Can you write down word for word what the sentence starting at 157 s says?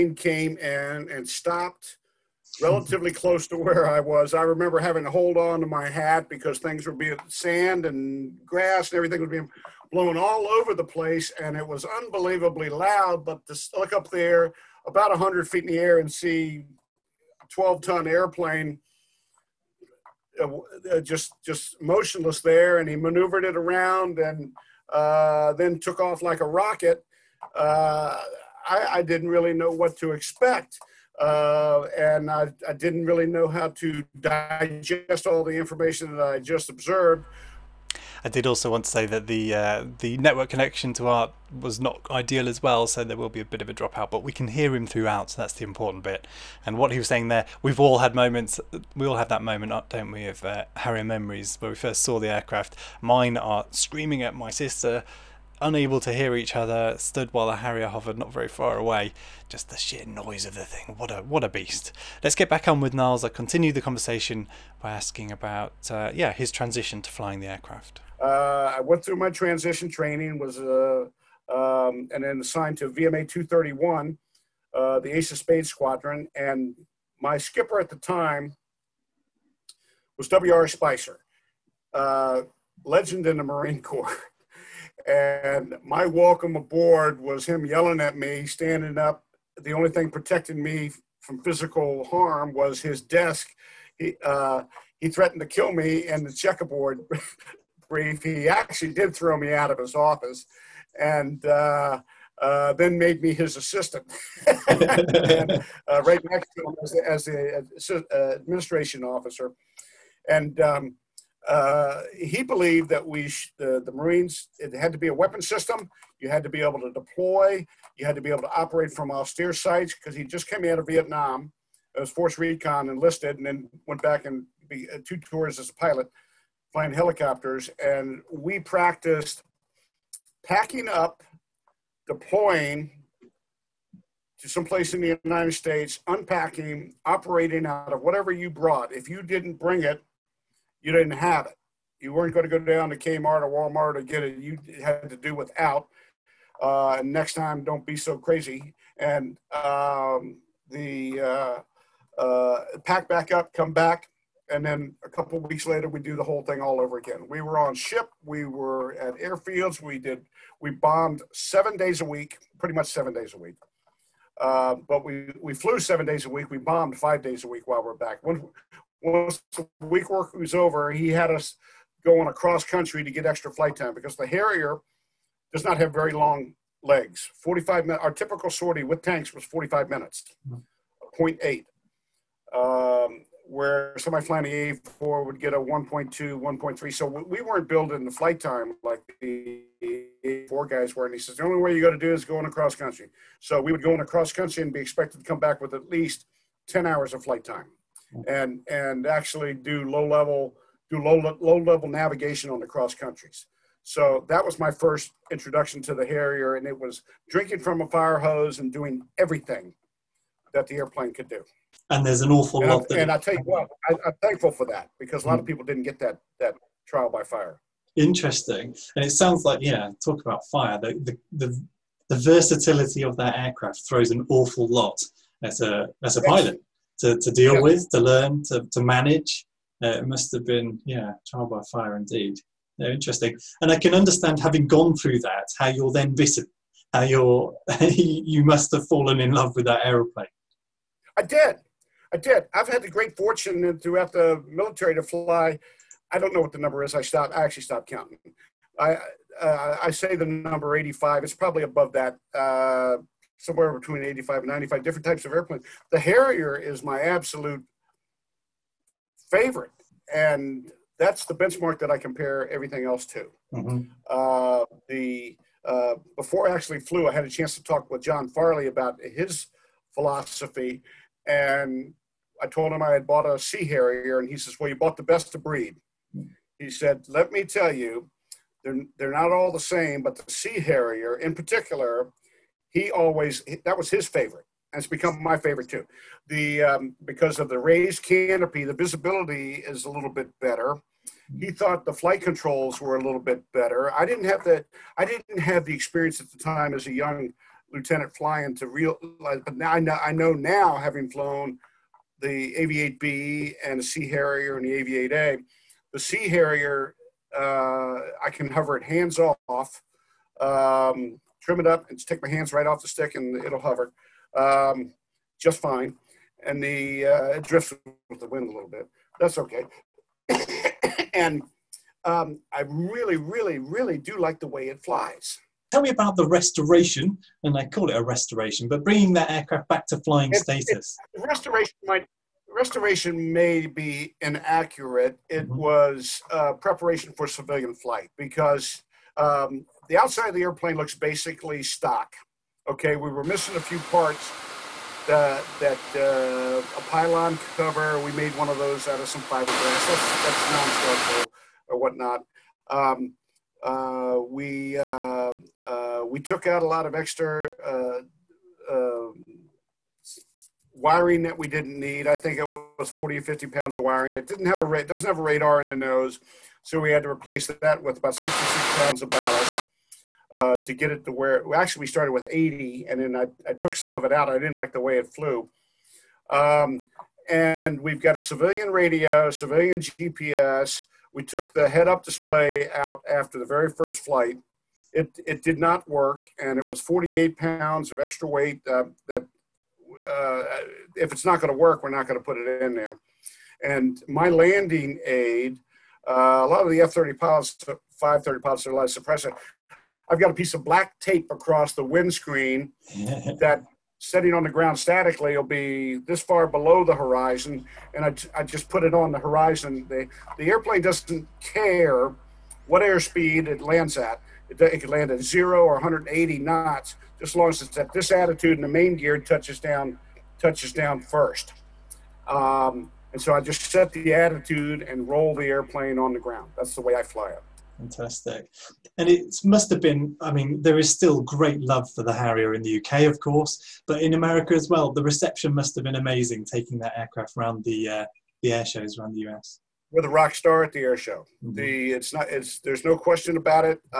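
We were on ship, we were at airfields, we did, we bombed seven days a week, pretty much seven days a week.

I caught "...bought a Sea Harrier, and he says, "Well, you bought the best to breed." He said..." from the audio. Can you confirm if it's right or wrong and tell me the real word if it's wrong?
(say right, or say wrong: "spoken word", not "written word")
right.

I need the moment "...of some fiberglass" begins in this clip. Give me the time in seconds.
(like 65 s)
348 s.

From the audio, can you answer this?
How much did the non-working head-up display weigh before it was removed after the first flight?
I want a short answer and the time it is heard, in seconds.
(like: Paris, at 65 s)
48 pounds, at 386 s.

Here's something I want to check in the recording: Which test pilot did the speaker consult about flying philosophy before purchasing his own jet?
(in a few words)
John Farley.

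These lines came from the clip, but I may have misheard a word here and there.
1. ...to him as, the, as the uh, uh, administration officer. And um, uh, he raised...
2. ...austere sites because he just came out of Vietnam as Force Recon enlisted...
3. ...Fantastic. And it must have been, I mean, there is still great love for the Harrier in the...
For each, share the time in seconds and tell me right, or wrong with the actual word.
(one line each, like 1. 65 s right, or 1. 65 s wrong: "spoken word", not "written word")
1. 106 s wrong: "believed", not "raised"
2. 119 s right
3. 427 s right.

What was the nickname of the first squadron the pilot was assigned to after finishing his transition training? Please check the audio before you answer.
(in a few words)
Ace of Spades.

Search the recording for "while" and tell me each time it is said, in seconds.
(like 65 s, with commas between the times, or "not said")
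57 s, 167 s.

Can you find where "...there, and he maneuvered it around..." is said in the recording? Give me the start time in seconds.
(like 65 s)
22 s.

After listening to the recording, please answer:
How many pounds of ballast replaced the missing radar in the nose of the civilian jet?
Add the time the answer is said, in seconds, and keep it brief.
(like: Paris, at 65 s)
66 pounds, at 368 s.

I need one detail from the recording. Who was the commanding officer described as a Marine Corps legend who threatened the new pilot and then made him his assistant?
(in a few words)
W.R. Spicer.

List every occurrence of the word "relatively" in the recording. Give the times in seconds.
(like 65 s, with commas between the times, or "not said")
2 s.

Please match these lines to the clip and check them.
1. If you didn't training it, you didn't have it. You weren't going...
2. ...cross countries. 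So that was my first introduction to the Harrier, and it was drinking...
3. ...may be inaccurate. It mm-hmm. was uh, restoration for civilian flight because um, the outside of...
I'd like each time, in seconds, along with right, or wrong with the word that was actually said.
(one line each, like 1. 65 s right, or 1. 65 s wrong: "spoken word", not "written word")
1. 138 s wrong: "bring", not "training"
2. 202 s right
3. 333 s wrong: "preparation", not "restoration".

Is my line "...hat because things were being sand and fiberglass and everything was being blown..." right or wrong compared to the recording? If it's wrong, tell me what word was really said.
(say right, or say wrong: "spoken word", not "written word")
wrong: "grass", not "fiberglass".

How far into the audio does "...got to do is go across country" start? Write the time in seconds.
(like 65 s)
191 s.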